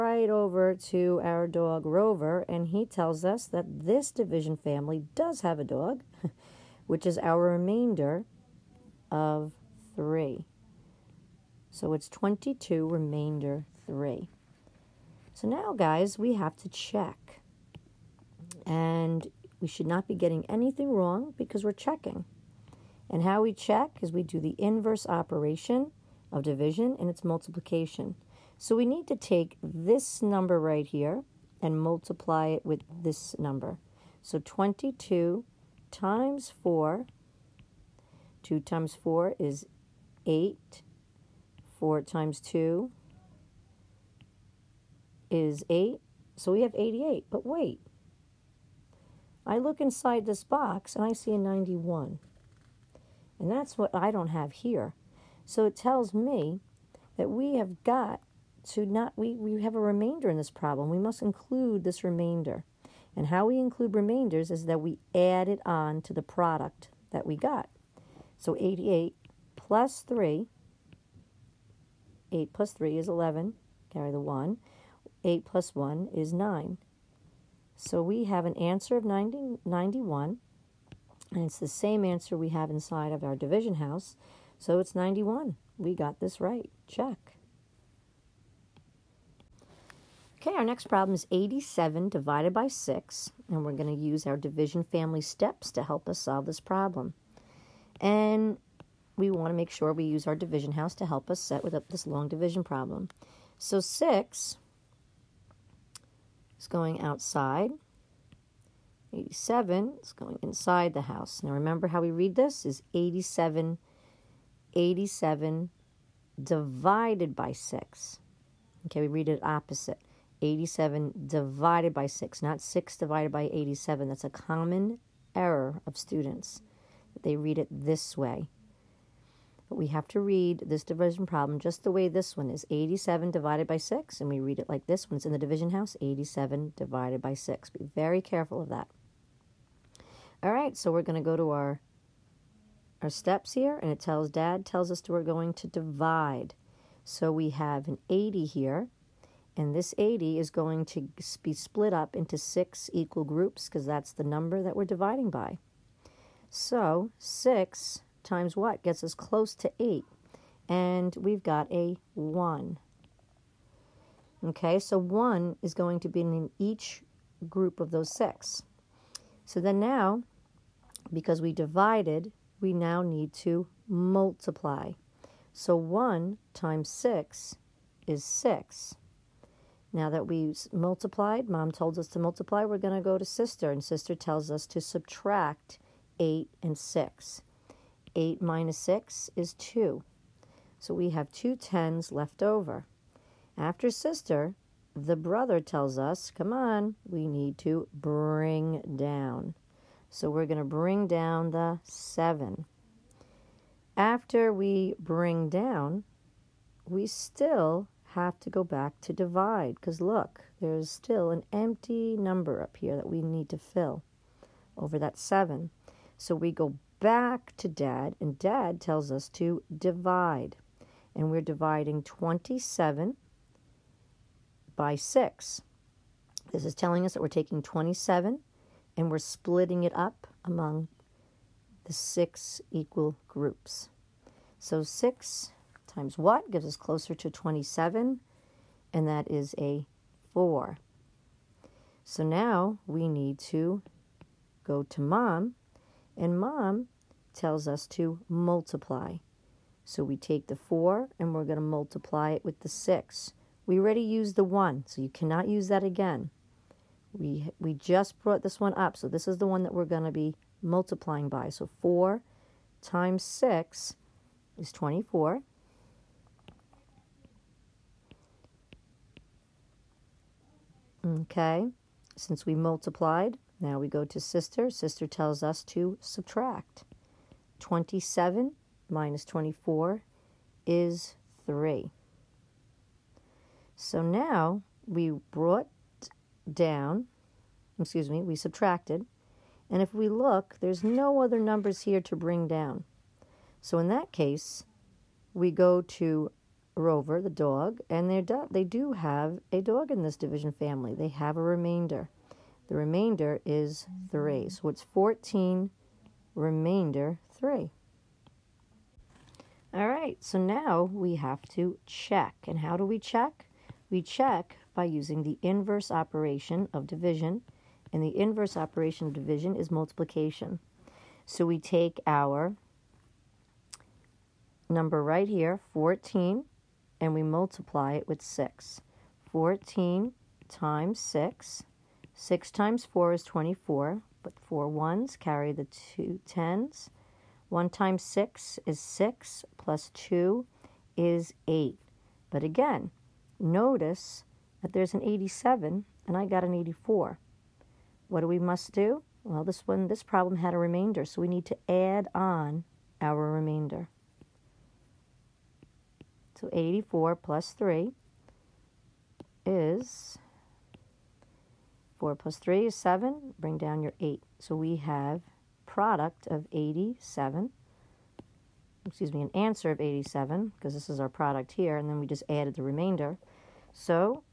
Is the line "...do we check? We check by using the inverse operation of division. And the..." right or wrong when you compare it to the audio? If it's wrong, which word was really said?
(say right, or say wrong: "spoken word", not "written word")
right.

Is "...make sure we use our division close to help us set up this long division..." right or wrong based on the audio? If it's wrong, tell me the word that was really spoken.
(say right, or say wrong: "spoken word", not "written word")
wrong: "house", not "close".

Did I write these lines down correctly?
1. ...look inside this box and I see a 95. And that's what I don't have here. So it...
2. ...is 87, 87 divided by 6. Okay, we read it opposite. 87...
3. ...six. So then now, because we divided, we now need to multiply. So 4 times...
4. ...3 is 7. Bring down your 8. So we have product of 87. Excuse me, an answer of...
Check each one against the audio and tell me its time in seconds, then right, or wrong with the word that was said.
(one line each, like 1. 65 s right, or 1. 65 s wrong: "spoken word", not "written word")
1. 49 s wrong: "91", not "95"
2. 112 s right
3. 168 s wrong: "1", not "4"
4. 362 s right.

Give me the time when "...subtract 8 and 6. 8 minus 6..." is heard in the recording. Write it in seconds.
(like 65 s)
184 s.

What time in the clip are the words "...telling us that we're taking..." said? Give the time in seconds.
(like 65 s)
226 s.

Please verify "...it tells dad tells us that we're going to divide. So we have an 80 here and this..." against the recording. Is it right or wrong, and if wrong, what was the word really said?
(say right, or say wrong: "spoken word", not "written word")
right.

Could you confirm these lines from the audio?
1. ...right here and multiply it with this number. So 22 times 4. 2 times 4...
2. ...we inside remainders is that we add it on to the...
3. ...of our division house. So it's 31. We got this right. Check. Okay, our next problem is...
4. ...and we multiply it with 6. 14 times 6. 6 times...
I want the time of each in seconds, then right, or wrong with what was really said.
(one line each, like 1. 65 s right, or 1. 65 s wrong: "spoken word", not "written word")
1. 30 s right
2. 63 s wrong: "include", not "inside"
3. 83 s wrong: "91", not "31"
4. 326 s right.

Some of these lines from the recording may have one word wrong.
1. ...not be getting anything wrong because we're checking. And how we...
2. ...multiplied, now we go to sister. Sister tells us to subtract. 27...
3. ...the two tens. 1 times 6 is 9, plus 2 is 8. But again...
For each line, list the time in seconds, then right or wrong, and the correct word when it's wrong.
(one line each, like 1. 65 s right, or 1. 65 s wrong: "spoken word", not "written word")
1. 19 s right
2. 272 s right
3. 335 s wrong: "6", not "9".